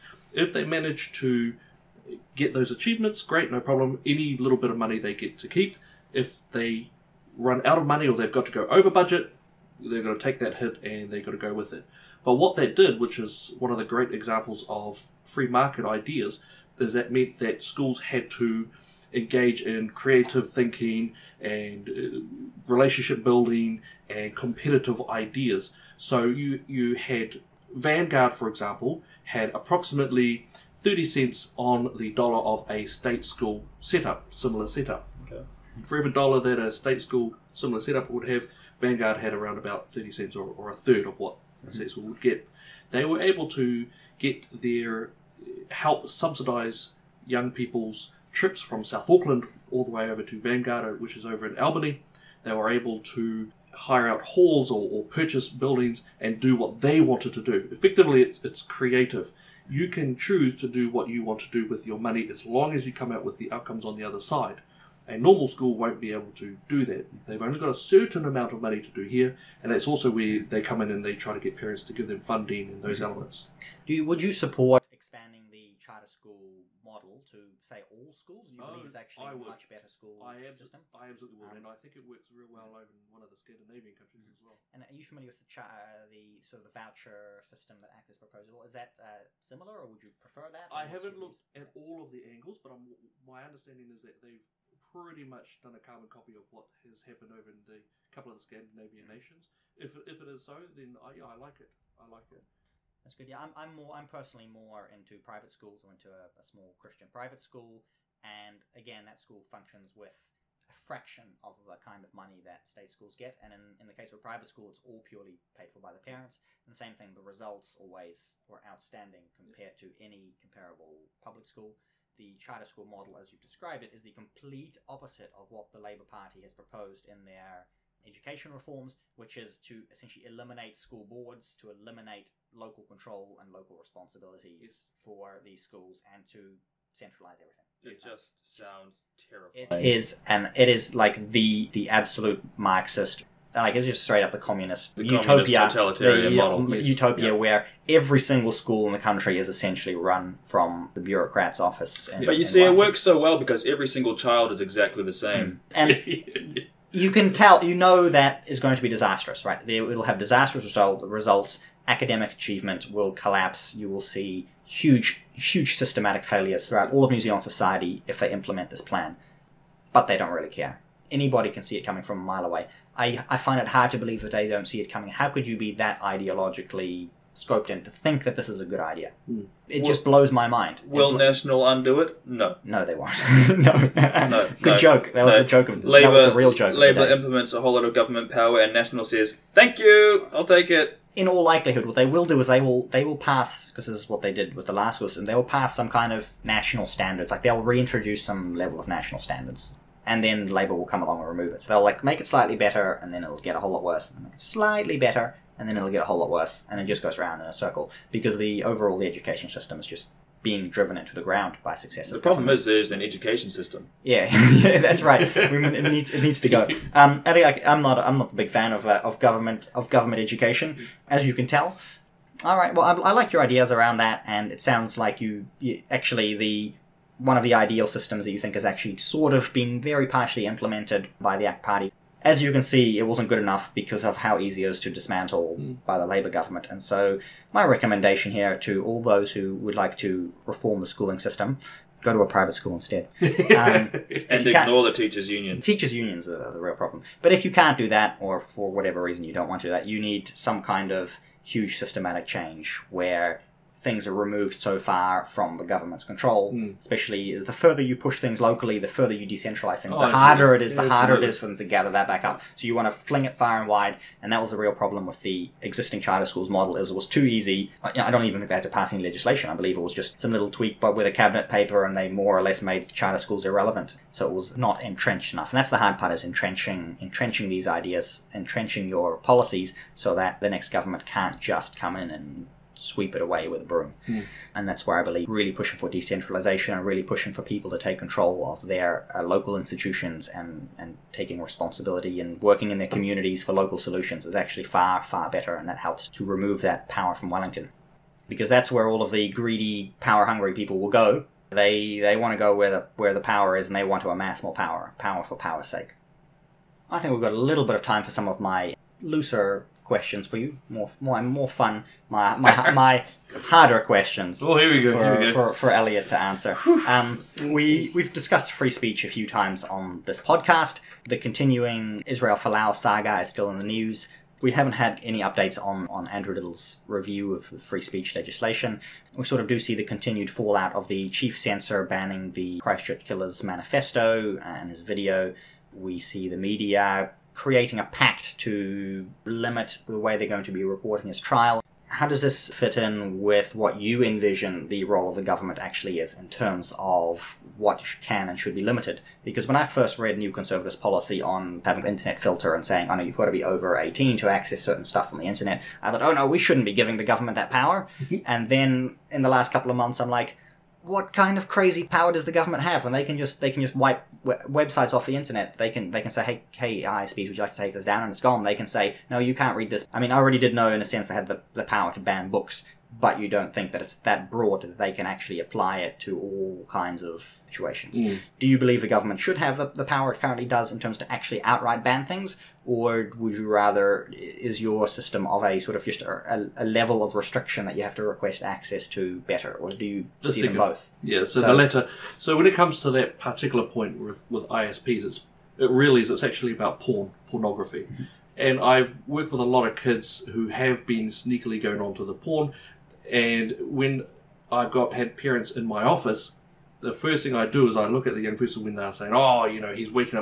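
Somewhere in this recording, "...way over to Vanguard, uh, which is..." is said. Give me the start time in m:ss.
0:49.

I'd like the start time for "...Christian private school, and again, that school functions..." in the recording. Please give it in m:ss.
1:46.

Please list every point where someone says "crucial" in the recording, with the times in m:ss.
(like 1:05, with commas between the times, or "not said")
not said.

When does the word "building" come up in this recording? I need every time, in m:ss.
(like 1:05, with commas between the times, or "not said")
0:23, 0:55.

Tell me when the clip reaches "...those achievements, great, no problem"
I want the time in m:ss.
0:02.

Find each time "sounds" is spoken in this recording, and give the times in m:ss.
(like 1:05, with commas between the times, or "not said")
2:18, 3:44.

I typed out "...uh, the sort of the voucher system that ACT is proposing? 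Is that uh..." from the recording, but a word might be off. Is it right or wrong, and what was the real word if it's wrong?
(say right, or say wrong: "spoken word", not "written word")
right.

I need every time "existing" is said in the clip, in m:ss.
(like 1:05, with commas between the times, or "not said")
4:25.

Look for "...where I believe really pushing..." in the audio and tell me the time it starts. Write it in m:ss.
4:44.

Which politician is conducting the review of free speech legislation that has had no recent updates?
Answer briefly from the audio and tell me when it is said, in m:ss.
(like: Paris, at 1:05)
Andrew Little, at 5:26.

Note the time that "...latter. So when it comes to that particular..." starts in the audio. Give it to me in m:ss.
6:31.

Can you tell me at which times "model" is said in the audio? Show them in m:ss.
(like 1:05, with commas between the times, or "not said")
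1:16, 2:02, 2:26, 4:26.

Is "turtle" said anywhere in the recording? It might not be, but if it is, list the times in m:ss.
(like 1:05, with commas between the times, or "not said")
not said.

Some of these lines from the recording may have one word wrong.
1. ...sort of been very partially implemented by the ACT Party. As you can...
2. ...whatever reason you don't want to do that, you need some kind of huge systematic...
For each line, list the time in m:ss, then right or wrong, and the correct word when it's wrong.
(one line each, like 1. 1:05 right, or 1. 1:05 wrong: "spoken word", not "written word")
1. 3:48 right
2. 4:08 right.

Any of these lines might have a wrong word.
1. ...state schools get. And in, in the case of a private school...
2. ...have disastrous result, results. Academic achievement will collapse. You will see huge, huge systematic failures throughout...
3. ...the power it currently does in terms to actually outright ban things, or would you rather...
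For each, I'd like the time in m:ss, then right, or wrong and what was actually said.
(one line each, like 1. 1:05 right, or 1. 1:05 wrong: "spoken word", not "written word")
1. 1:52 right
2. 2:40 right
3. 6:19 right.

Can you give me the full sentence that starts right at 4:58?
Because that's where all of the greedy, power hungry people will go.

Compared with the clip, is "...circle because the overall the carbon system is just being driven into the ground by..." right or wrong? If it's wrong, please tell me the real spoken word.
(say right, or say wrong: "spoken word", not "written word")
wrong: "education", not "carbon".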